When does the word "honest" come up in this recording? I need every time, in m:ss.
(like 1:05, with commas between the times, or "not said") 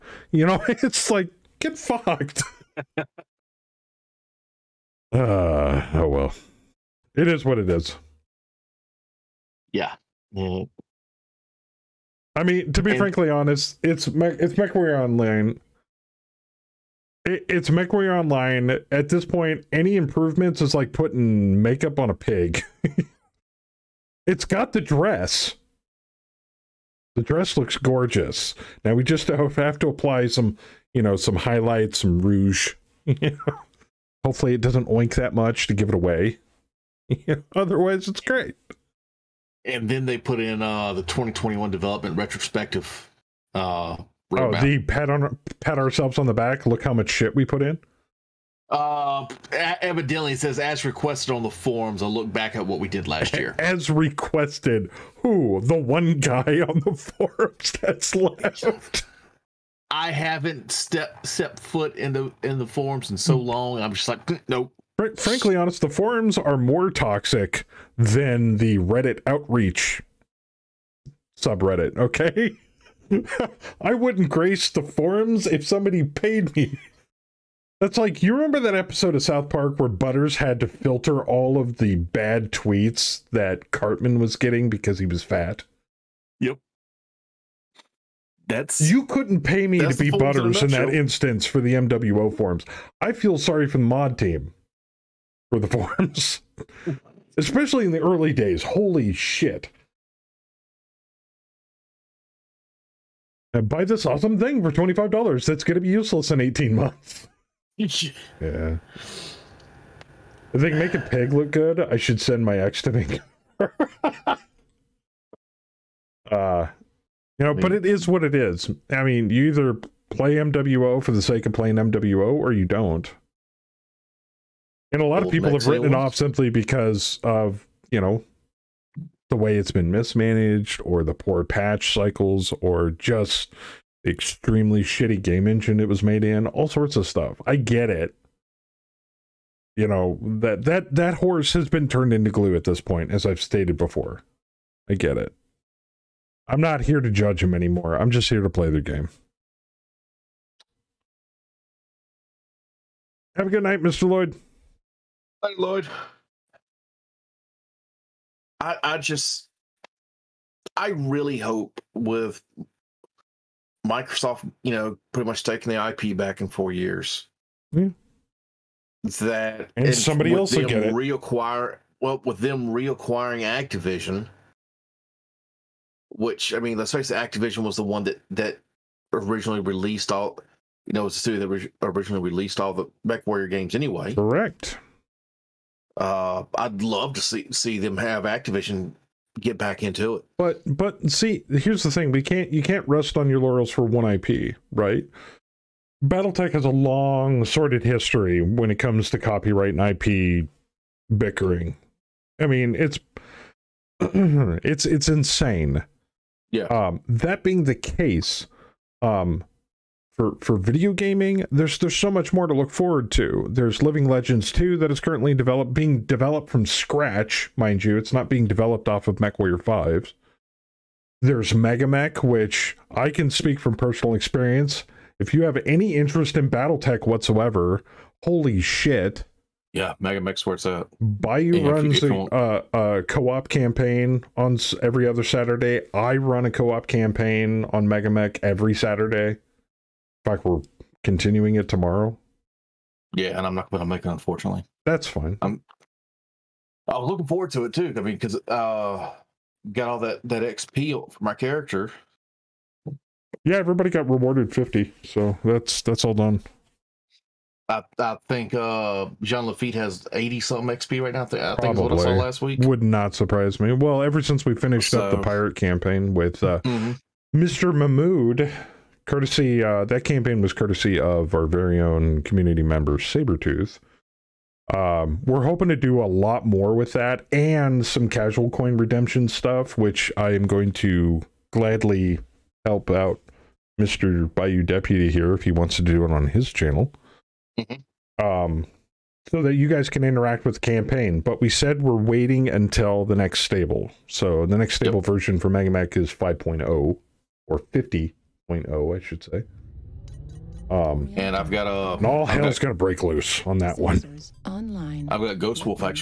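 0:13, 1:05.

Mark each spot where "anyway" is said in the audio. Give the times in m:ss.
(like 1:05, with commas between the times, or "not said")
3:03.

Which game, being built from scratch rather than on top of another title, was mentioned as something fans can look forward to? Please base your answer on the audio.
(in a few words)
Living Legends 2.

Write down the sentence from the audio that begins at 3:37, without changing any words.
It's not being developed off of MechWarrior 5.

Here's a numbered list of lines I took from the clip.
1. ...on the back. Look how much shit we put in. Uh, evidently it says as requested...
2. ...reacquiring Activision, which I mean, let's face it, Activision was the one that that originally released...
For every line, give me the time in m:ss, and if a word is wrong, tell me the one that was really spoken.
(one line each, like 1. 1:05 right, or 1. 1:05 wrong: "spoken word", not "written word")
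1. 0:46 right
2. 2:52 right.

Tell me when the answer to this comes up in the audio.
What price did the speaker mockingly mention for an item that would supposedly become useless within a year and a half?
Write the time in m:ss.
1:44.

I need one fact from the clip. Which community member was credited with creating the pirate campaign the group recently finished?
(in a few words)
Sabretooth.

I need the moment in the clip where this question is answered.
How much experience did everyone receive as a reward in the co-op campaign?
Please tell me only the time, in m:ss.
4:14.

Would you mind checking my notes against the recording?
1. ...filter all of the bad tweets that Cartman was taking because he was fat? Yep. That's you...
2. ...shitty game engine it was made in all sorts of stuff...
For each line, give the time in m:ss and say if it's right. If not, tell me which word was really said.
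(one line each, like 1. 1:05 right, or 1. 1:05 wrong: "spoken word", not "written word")
1. 1:20 wrong: "getting", not "taking"
2. 2:14 right.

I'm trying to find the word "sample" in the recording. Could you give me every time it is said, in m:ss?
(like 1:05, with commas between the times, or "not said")
not said.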